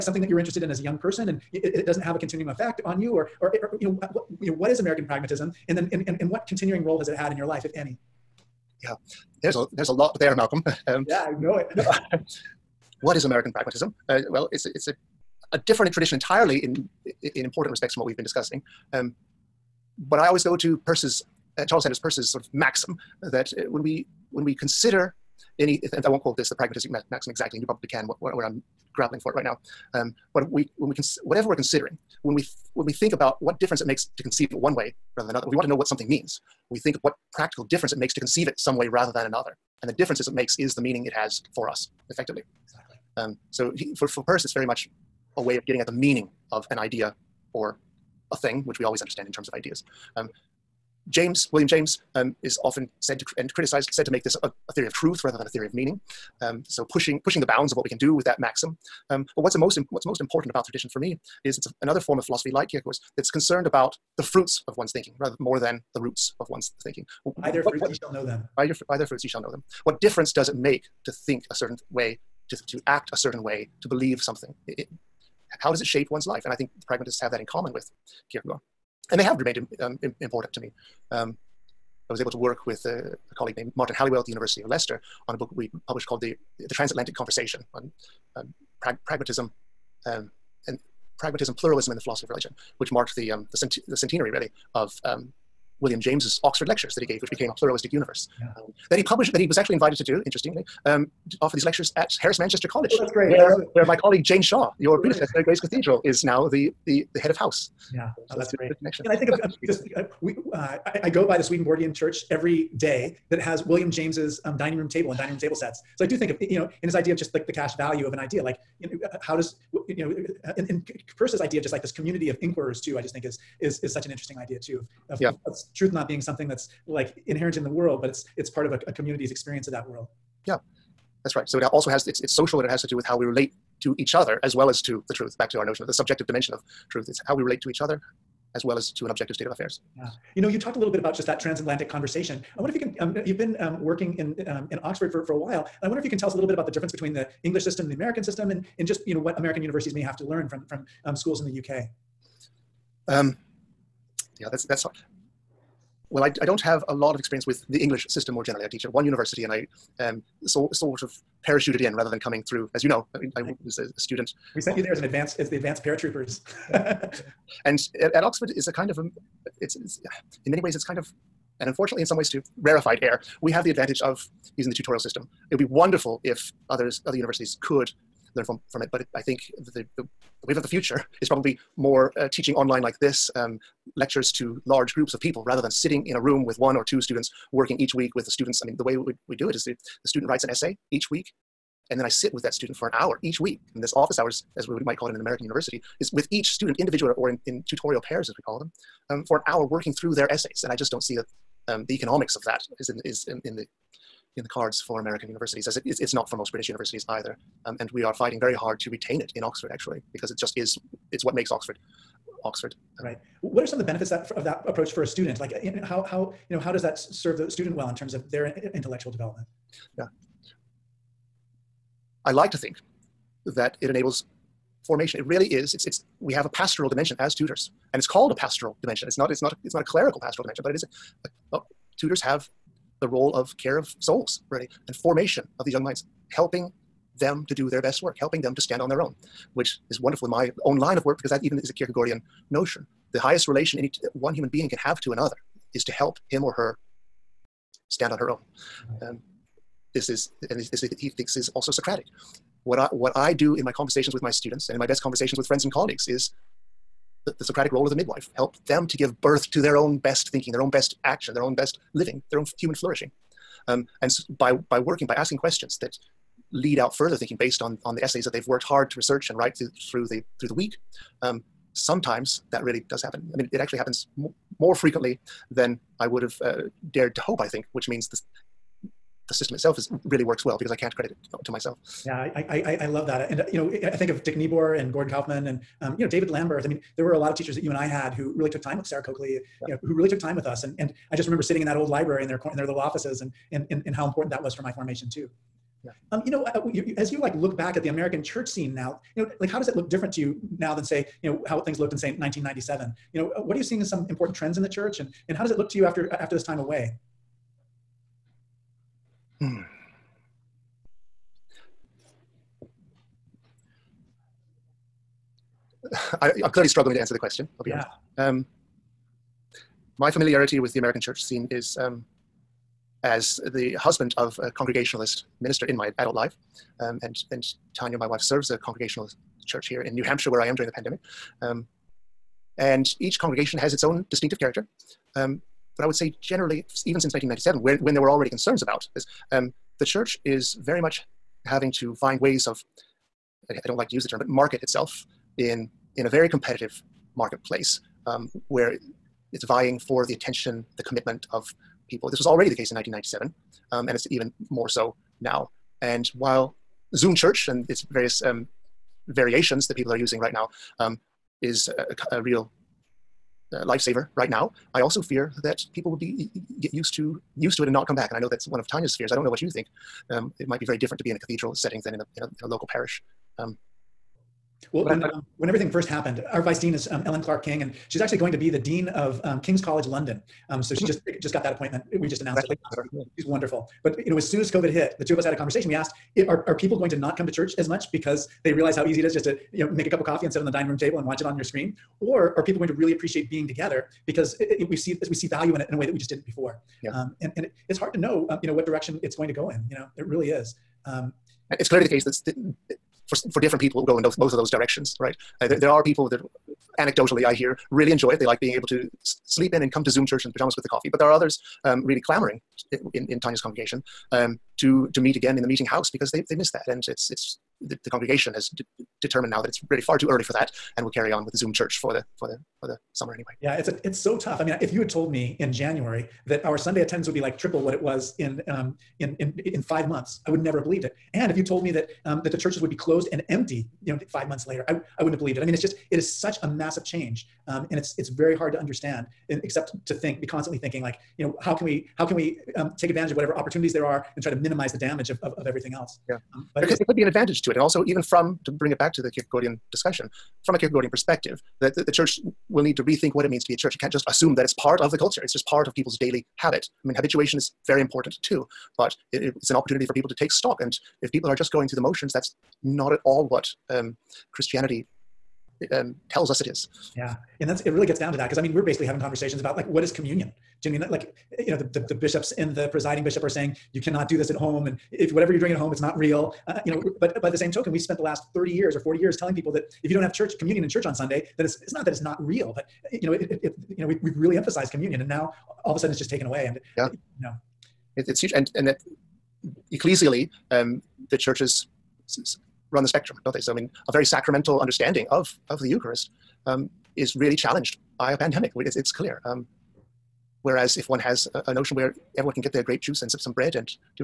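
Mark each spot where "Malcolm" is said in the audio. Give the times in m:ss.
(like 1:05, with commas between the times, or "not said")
0:10.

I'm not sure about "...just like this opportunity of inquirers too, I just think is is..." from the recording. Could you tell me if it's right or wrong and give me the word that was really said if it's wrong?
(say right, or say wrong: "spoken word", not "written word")
wrong: "community", not "opportunity".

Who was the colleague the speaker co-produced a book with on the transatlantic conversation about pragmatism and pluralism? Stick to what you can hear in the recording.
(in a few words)
Martin Halliwell.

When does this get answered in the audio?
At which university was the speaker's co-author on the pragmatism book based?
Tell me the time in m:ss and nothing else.
1:24.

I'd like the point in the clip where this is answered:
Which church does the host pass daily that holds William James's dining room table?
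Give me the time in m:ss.
1:51.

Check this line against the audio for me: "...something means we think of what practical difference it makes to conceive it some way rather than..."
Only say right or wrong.
right.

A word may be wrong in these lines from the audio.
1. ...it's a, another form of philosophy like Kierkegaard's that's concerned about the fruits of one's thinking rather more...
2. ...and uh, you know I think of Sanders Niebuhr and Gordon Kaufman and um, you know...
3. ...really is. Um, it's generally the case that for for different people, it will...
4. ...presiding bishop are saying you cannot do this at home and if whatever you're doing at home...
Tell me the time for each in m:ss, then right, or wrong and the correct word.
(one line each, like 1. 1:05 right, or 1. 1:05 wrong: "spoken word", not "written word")
1. 1:01 right
2. 4:43 wrong: "Dick", not "Sanders"
3. 6:40 wrong: "clearly", not "generally"
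4. 7:52 right.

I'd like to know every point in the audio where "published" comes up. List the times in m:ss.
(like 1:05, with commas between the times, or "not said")
1:25, 1:39.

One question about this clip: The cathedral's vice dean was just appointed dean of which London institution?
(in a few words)
King's College London.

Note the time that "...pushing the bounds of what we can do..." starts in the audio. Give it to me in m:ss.
0:57.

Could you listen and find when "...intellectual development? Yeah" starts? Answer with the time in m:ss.
3:38.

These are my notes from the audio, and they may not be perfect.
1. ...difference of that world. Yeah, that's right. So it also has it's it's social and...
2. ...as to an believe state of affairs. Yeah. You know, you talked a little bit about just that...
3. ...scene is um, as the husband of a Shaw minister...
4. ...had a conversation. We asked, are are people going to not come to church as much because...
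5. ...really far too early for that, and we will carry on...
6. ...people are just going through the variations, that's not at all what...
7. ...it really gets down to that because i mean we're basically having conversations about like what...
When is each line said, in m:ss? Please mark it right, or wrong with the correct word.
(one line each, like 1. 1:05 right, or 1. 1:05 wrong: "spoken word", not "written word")
1. 2:09 wrong: "experience", not "difference"
2. 2:18 wrong: "objective", not "believe"
3. 5:21 wrong: "Congregationalist", not "Shaw"
4. 6:25 right
5. 6:59 right
6. 7:41 wrong: "motions", not "variations"
7. 7:47 right.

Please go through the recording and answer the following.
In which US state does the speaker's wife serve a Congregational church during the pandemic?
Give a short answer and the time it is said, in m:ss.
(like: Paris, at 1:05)
New Hampshire, at 5:29.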